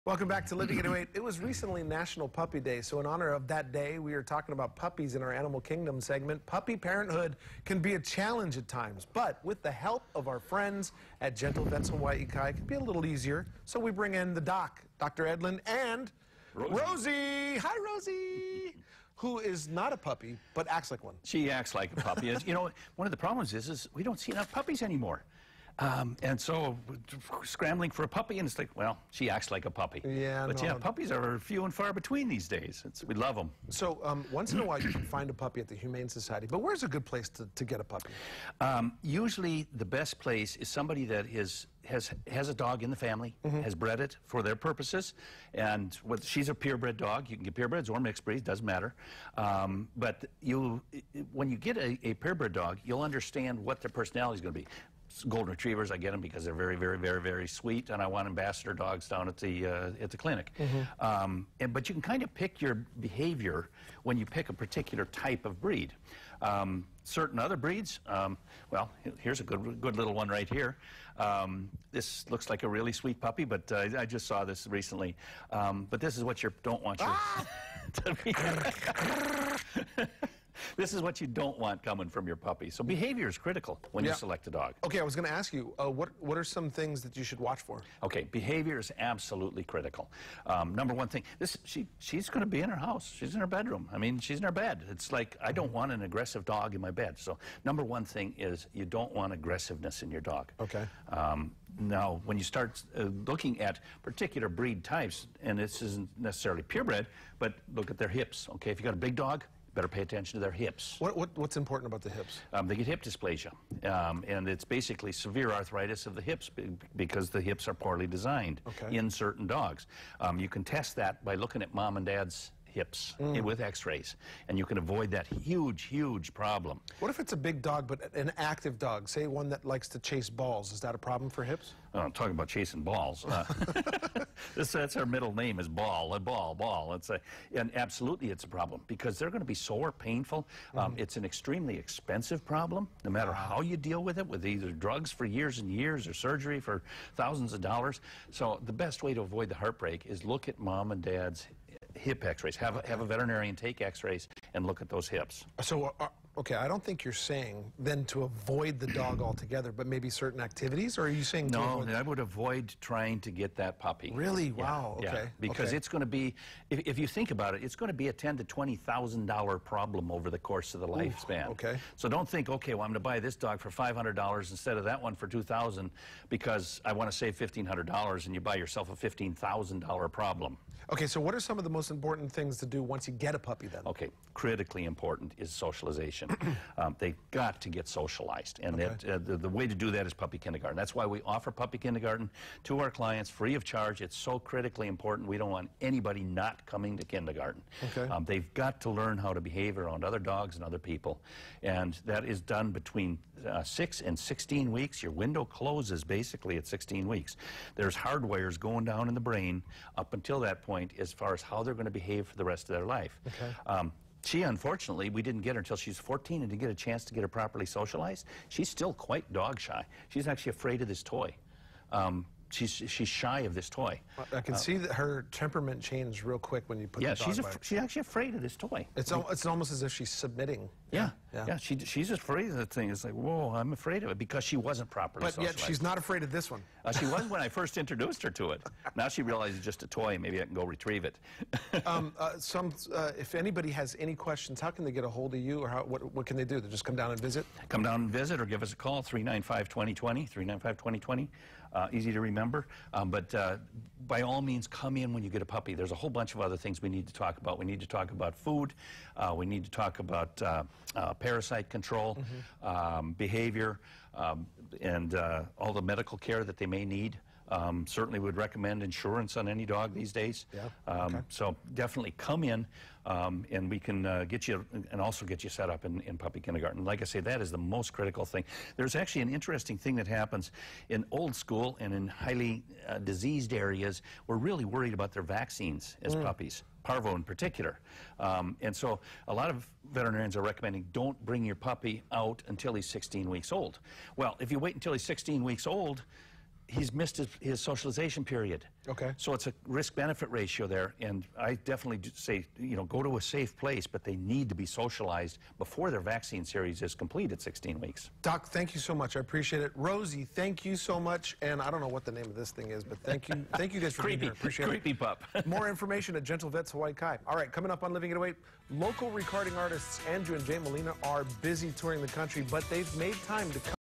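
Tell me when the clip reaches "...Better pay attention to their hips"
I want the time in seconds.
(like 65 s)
109 s.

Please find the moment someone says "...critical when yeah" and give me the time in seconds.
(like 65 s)
83 s.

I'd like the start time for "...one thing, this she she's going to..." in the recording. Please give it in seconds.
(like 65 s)
90 s.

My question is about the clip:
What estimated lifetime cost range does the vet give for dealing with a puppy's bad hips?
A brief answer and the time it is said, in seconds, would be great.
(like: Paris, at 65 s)
$10,000 to $20,000, at 168 s.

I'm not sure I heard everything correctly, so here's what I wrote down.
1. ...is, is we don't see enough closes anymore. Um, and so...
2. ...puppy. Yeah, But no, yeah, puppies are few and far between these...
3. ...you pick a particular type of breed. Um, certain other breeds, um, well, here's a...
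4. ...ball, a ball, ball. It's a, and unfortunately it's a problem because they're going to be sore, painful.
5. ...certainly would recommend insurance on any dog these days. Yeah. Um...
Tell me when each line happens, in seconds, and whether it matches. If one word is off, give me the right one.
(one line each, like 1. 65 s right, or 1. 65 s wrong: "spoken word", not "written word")
1. 23 s wrong: "puppies", not "closes"
2. 29 s right
3. 64 s right
4. 135 s wrong: "absolutely", not "unfortunately"
5. 267 s right.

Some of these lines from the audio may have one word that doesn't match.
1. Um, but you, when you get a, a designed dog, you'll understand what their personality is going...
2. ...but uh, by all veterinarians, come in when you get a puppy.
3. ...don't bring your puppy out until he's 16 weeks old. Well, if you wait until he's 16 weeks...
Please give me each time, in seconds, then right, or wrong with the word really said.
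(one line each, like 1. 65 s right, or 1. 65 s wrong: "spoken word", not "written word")
1. 49 s wrong: "purebred", not "designed"
2. 253 s wrong: "means", not "veterinarians"
3. 290 s right.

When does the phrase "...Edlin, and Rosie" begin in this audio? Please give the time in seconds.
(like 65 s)
15 s.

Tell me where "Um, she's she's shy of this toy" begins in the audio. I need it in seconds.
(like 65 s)
221 s.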